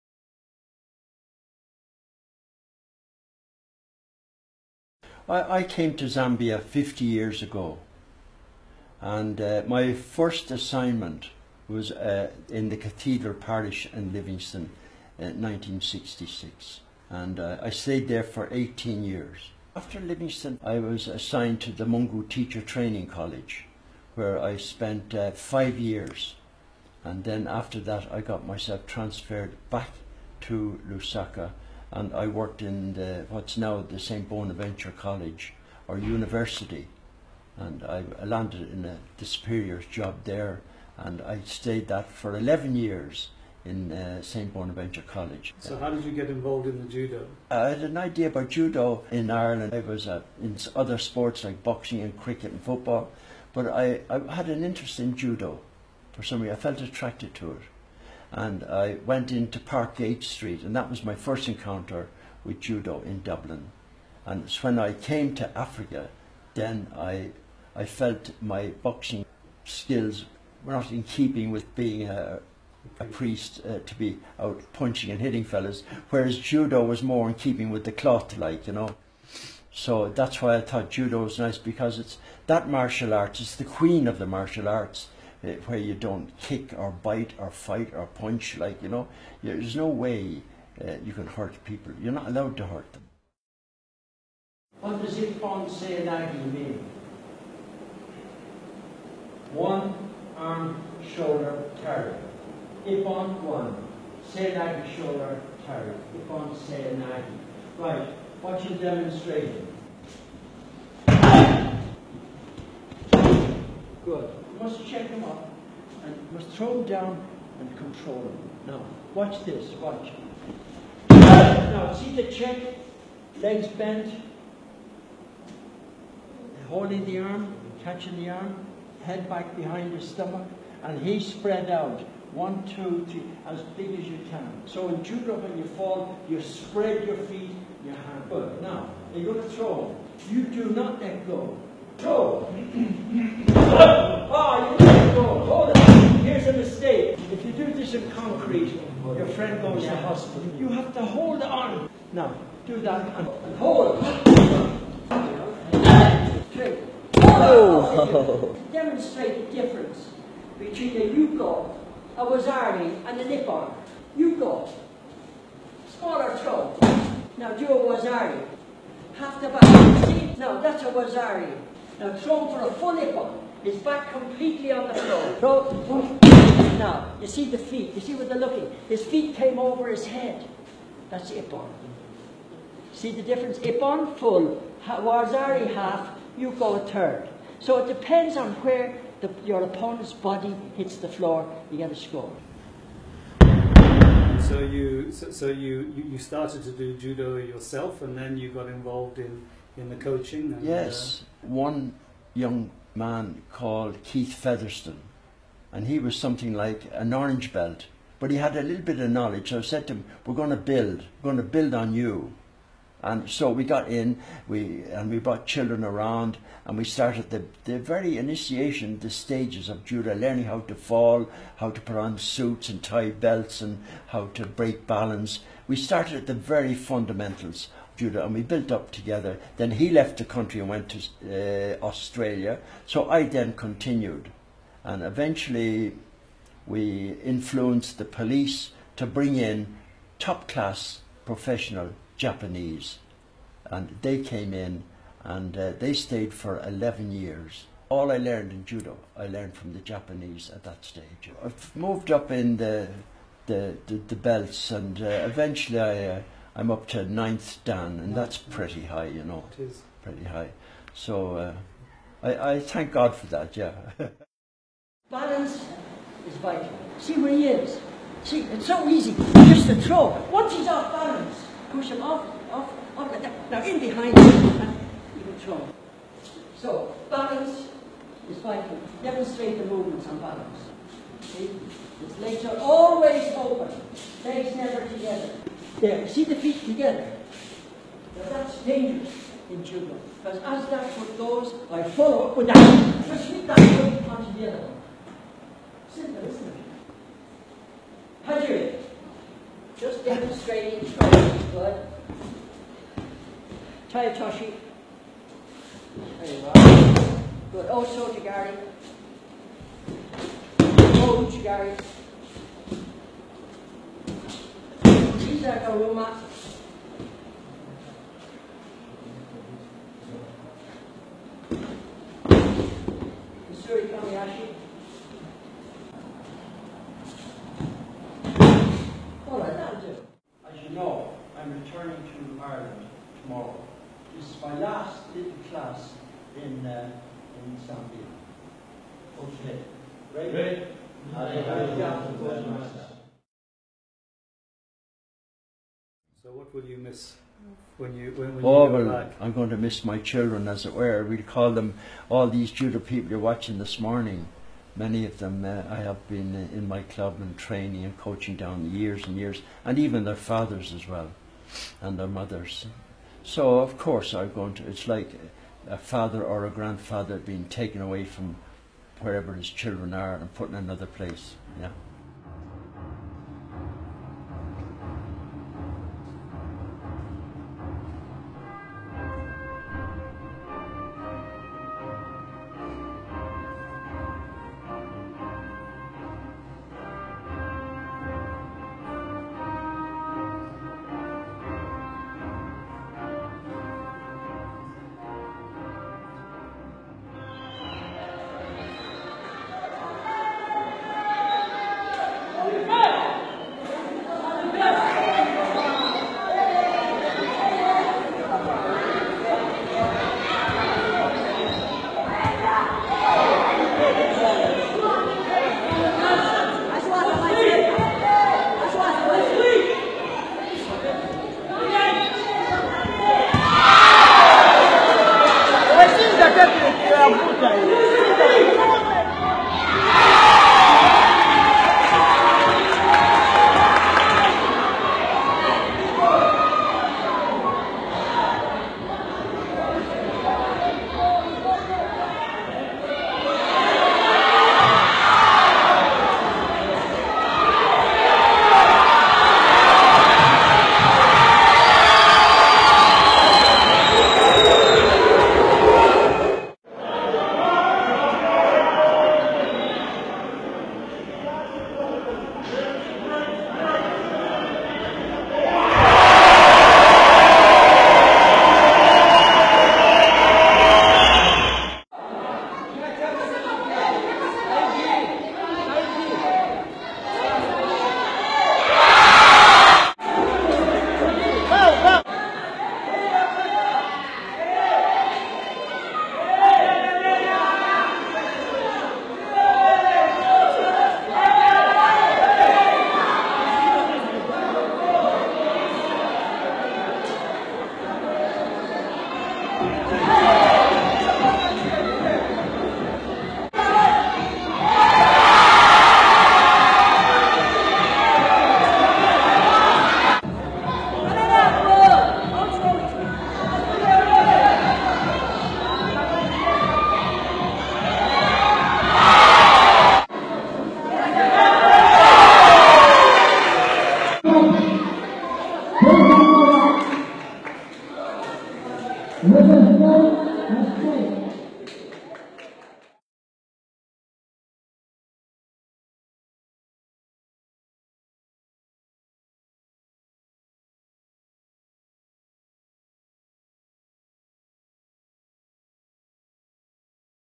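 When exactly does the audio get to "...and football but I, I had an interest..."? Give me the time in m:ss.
0:52.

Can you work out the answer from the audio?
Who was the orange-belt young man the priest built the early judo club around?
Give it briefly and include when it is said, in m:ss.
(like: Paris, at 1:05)
Keith Featherstone, at 3:24.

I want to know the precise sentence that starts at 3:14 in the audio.
So you, so, so you, you started to do judo yourself, and then you got involved in, in the coaching.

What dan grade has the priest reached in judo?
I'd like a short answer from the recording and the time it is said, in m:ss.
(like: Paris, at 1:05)
ninth dan, at 4:17.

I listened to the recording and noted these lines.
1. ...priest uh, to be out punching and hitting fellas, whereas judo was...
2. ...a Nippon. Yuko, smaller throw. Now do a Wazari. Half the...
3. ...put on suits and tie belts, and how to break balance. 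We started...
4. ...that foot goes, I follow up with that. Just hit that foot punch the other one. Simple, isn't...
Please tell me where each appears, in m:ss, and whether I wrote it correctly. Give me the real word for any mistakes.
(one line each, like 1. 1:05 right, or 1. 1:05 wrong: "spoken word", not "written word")
1. 1:13 right
2. 2:43 right
3. 3:41 right
4. 4:50 right.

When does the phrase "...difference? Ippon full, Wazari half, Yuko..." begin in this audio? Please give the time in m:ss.
3:03.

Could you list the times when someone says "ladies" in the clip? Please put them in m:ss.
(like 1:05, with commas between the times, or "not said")
not said.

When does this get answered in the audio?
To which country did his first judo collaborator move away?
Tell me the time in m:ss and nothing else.
3:51.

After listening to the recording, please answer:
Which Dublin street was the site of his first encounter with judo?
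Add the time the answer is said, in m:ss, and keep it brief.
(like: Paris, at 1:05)
Parkgate Street, at 0:59.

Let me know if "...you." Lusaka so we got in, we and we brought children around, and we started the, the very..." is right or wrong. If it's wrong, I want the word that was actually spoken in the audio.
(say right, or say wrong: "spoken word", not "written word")
wrong: "And", not "Lusaka".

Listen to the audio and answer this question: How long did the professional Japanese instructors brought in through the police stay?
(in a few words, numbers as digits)
11 years.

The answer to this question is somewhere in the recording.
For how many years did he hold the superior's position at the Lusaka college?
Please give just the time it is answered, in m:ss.
0:42.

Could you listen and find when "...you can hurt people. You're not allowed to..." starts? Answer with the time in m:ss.
1:31.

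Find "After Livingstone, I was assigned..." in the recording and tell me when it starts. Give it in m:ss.
0:19.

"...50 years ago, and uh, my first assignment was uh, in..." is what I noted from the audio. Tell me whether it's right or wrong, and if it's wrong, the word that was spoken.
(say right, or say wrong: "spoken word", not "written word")
right.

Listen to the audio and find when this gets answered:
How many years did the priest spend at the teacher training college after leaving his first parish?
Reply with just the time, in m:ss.
0:25.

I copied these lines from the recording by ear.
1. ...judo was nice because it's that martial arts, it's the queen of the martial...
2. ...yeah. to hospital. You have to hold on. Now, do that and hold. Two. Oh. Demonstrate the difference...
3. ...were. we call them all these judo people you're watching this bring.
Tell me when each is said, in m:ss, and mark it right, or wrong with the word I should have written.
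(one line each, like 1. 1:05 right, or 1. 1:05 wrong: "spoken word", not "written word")
1. 1:20 right
2. 2:29 right
3. 5:50 wrong: "morning", not "bring".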